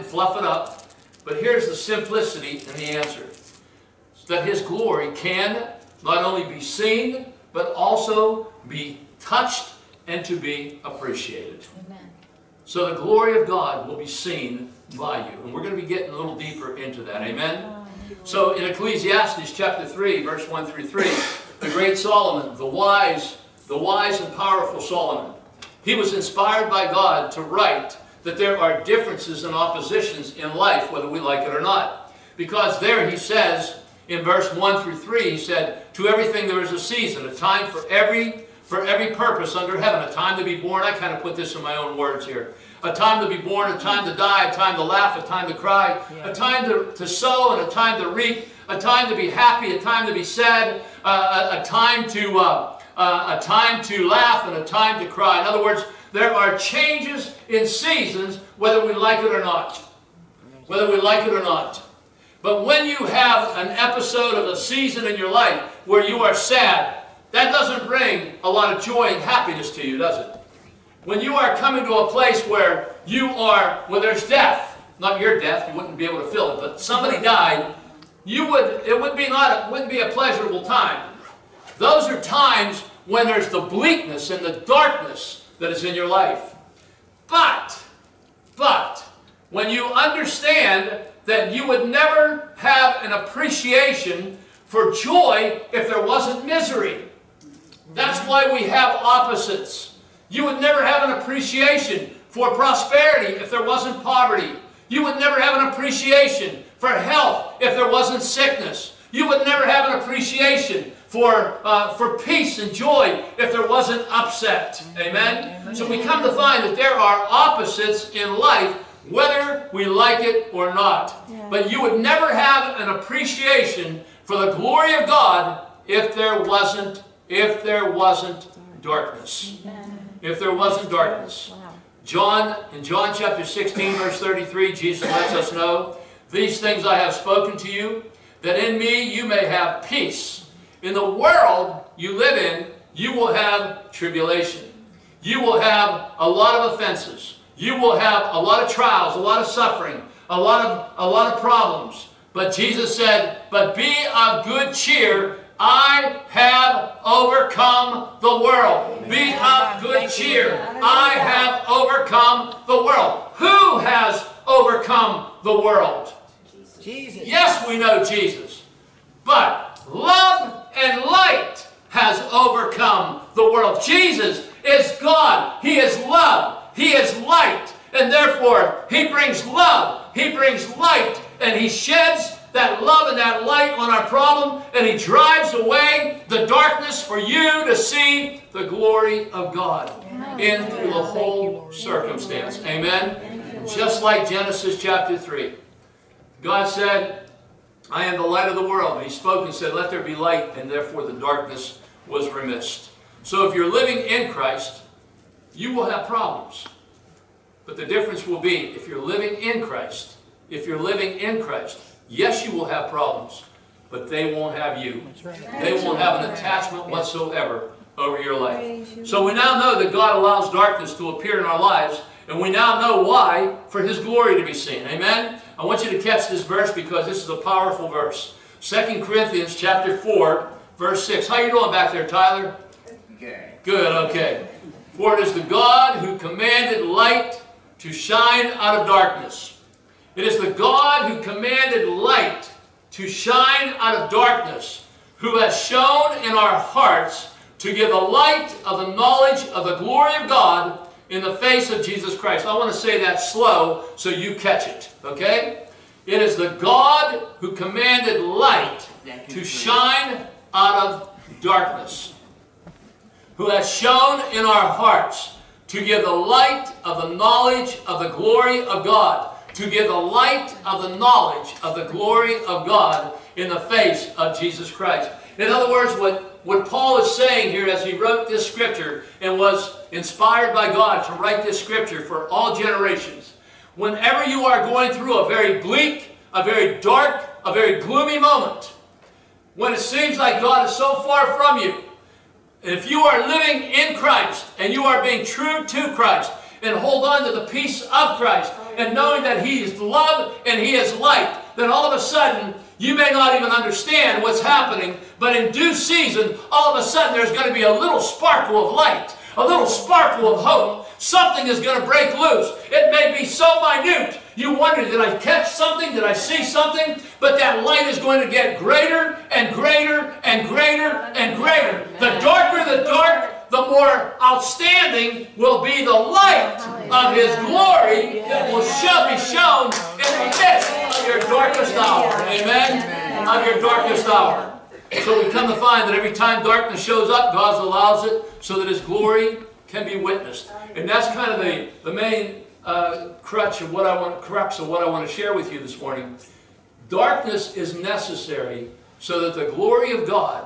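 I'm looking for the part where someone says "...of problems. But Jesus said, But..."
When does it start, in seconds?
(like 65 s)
151 s.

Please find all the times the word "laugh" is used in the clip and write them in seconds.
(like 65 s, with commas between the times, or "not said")
44 s, 54 s.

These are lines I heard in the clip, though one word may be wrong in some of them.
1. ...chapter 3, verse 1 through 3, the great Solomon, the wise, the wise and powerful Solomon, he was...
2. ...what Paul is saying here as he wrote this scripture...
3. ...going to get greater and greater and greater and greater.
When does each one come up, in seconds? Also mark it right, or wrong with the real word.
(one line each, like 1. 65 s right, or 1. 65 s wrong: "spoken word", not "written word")
1. 19 s right
2. 276 s right
3. 317 s right.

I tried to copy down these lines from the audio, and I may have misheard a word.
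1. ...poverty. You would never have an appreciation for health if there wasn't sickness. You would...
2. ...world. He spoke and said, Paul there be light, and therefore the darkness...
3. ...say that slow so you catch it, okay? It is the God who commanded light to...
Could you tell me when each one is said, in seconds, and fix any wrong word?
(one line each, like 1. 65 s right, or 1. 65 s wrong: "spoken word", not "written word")
1. 104 s right
2. 198 s wrong: "Let", not "Paul"
3. 252 s right.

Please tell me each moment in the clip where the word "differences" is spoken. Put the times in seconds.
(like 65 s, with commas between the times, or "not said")
28 s, 207 s.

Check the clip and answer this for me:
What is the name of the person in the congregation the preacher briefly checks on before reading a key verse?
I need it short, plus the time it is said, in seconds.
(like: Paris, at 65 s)
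Tyler, at 232 s.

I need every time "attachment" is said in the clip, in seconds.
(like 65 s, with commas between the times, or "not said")
216 s.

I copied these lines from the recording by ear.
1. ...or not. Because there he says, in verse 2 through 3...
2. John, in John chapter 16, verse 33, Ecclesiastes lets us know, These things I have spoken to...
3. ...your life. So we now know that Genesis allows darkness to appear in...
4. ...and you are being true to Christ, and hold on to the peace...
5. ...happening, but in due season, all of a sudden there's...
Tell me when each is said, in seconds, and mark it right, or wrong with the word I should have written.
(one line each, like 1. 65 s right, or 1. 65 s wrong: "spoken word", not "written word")
1. 31 s wrong: "1", not "2"
2. 132 s wrong: "Jesus", not "Ecclesiastes"
3. 218 s wrong: "God", not "Genesis"
4. 294 s right
5. 304 s right.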